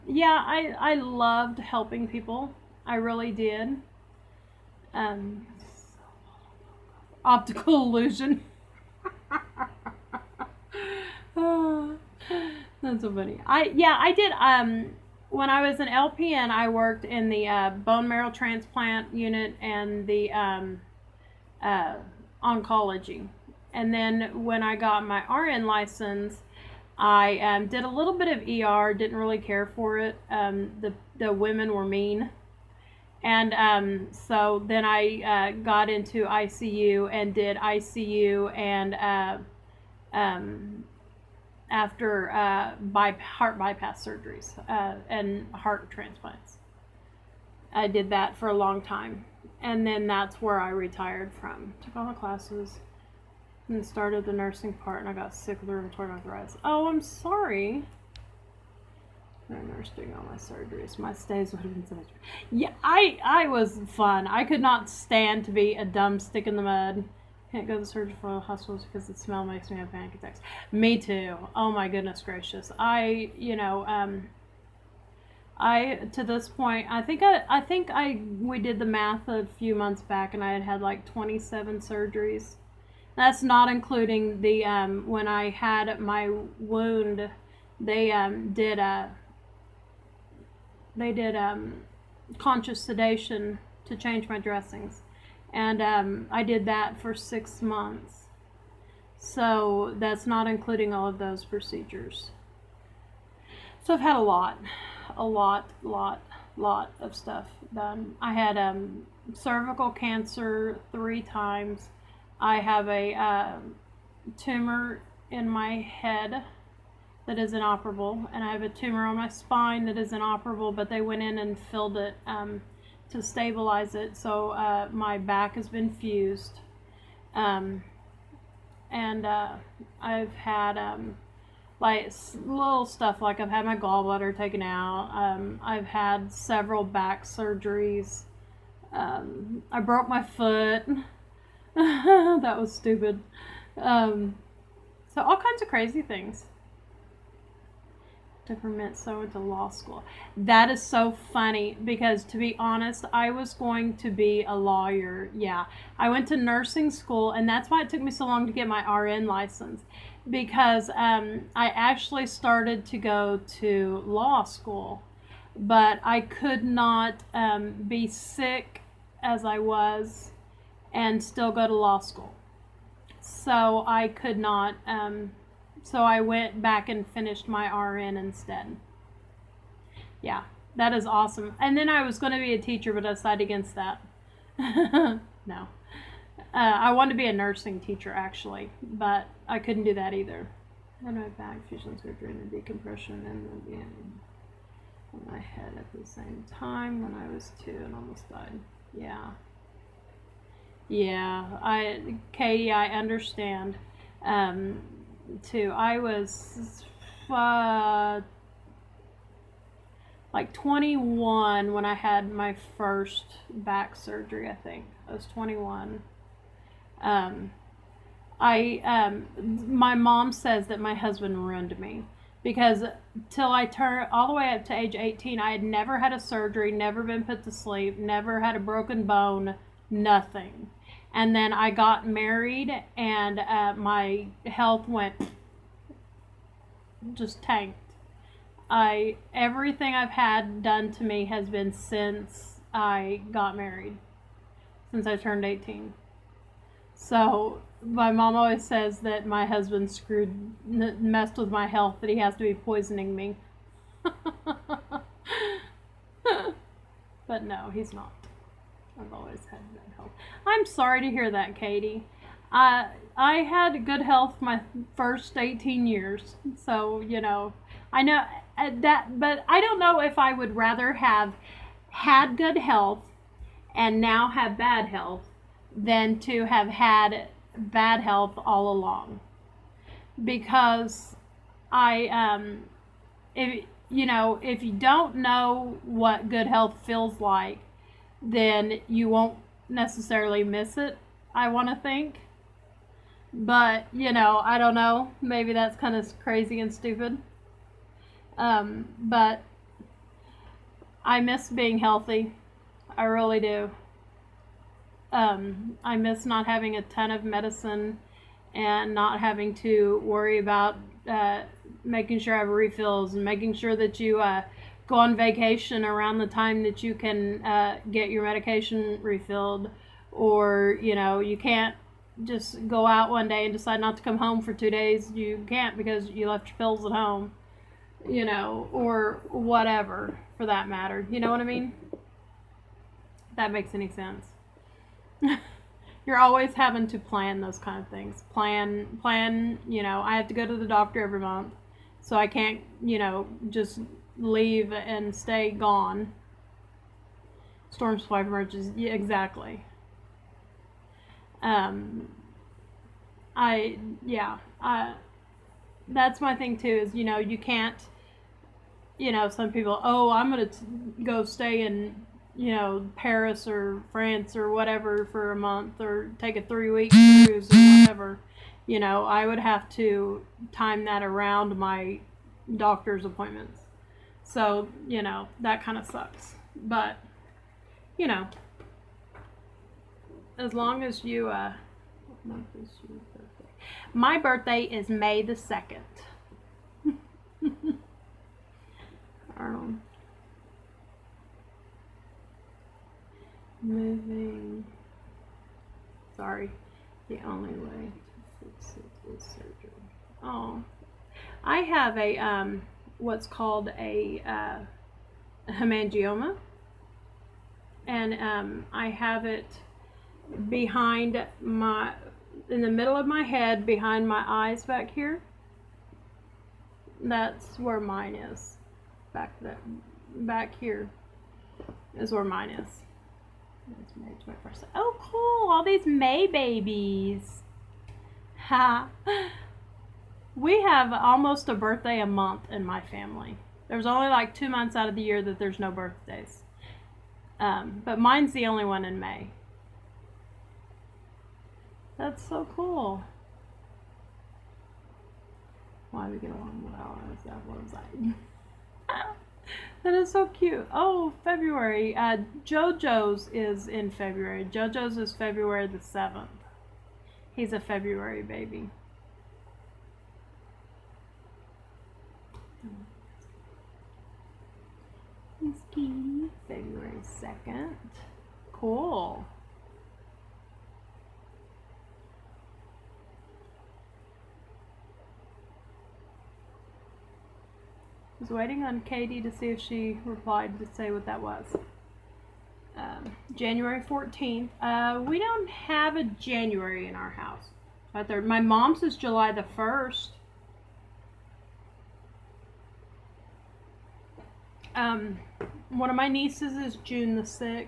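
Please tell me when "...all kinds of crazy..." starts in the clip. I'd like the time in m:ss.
2:25.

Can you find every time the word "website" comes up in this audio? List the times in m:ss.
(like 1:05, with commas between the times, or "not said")
7:27.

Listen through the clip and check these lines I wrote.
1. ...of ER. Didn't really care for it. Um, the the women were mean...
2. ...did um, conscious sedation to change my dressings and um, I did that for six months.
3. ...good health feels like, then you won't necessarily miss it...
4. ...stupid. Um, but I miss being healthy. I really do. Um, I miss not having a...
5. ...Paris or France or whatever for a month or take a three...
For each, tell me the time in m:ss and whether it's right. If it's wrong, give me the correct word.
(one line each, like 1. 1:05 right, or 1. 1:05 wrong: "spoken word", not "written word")
1. 0:28 right
2. 1:31 right
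3. 4:46 right
4. 4:56 right
5. 6:02 right.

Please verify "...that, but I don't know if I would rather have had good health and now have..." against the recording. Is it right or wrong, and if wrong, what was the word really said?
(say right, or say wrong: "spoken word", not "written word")
right.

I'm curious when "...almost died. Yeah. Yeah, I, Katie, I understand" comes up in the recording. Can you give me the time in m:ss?
3:17.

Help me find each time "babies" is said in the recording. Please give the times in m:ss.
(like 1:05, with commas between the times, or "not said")
7:06.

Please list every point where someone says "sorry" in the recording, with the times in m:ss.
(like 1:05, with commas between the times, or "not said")
0:57, 4:20, 6:36.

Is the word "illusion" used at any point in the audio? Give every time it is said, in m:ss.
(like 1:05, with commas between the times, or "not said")
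0:07.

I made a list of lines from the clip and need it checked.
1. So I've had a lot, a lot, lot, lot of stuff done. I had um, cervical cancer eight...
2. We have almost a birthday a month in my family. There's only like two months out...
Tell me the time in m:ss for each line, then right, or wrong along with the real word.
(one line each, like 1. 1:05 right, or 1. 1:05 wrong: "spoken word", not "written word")
1. 1:43 wrong: "three", not "eight"
2. 7:10 right.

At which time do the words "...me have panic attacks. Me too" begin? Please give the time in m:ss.
1:09.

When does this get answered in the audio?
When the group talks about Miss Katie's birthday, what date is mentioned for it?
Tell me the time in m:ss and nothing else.
7:46.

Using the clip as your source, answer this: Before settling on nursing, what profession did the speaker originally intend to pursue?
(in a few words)
Lawyer.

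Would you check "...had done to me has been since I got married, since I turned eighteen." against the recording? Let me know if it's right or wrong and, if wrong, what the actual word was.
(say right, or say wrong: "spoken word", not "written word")
right.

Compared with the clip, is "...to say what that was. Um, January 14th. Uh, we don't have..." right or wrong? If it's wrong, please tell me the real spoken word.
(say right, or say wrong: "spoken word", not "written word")
right.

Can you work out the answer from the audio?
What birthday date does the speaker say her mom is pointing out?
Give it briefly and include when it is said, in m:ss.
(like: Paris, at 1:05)
July 1, at 8:08.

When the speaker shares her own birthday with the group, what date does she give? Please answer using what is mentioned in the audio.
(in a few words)
May 2.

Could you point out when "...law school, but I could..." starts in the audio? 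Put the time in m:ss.
2:44.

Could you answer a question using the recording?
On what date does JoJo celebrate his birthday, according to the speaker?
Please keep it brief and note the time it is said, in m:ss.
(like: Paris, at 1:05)
February 7, at 7:35.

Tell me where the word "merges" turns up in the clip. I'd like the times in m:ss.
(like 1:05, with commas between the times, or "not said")
5:48.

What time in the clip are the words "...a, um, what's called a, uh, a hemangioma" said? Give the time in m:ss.
6:41.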